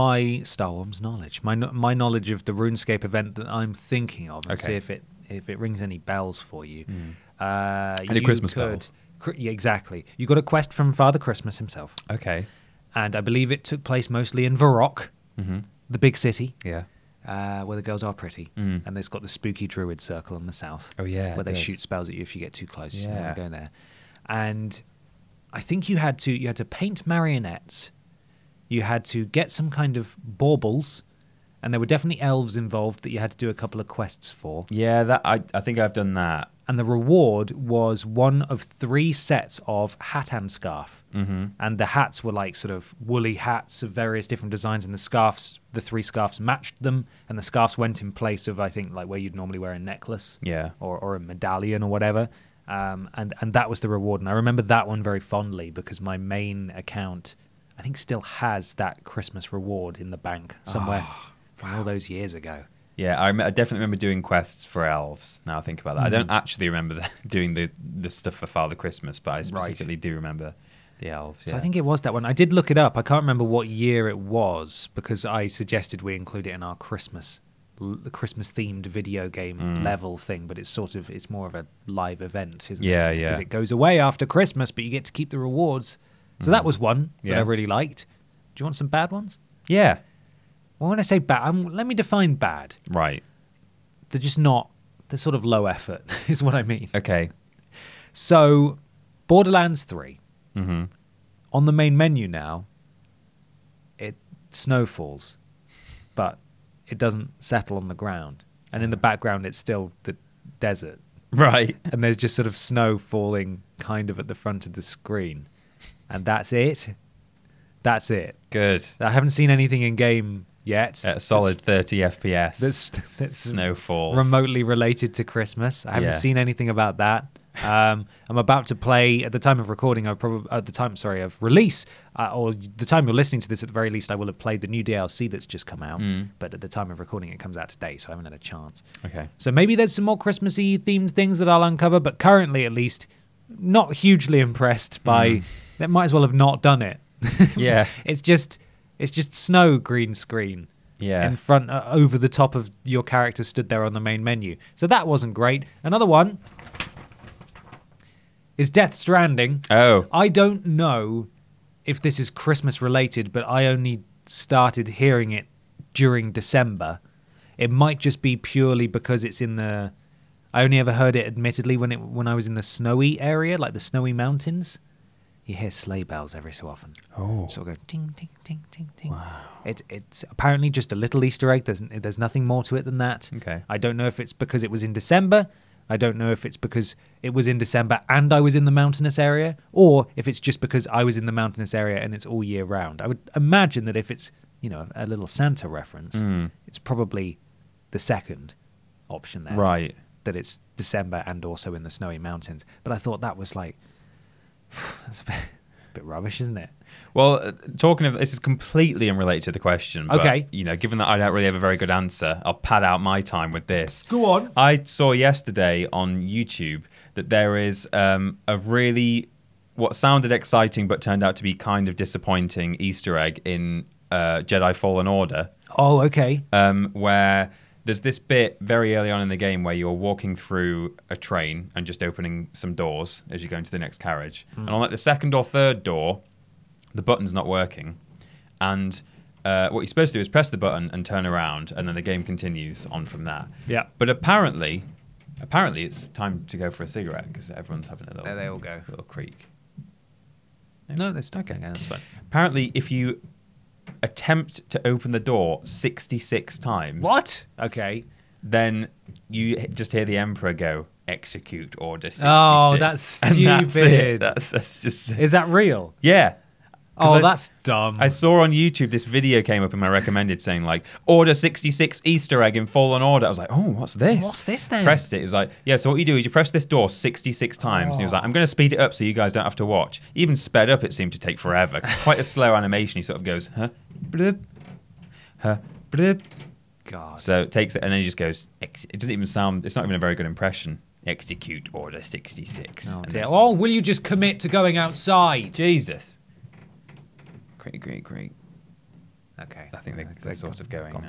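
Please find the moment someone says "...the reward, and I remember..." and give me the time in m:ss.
0:53.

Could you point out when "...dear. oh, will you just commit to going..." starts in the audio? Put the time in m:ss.
4:53.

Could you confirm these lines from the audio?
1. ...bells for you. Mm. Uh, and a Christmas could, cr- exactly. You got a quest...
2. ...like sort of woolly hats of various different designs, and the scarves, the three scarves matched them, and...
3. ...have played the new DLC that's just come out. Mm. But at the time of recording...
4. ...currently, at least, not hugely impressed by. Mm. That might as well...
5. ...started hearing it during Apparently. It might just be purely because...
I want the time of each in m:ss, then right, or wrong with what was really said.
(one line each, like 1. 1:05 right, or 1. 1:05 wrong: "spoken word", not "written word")
1. 0:05 right
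2. 0:42 right
3. 2:14 right
4. 2:22 right
5. 2:44 wrong: "December", not "Apparently".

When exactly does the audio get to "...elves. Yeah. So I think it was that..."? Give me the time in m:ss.
1:11.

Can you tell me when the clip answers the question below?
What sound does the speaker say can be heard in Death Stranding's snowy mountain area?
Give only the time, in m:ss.
2:55.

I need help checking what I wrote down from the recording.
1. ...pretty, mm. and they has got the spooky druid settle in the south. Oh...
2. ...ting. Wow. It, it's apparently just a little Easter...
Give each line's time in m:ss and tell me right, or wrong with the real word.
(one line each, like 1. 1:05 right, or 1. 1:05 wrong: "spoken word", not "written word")
1. 0:18 wrong: "circle", not "settle"
2. 2:58 right.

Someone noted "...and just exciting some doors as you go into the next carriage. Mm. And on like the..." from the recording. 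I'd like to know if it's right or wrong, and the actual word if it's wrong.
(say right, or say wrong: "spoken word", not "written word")
wrong: "opening", not "exciting".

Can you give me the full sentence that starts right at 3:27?
Well, uh, talking of this is completely unrelated to the question.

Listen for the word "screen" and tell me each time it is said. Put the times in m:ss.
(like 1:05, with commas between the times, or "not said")
1:54, 2:30.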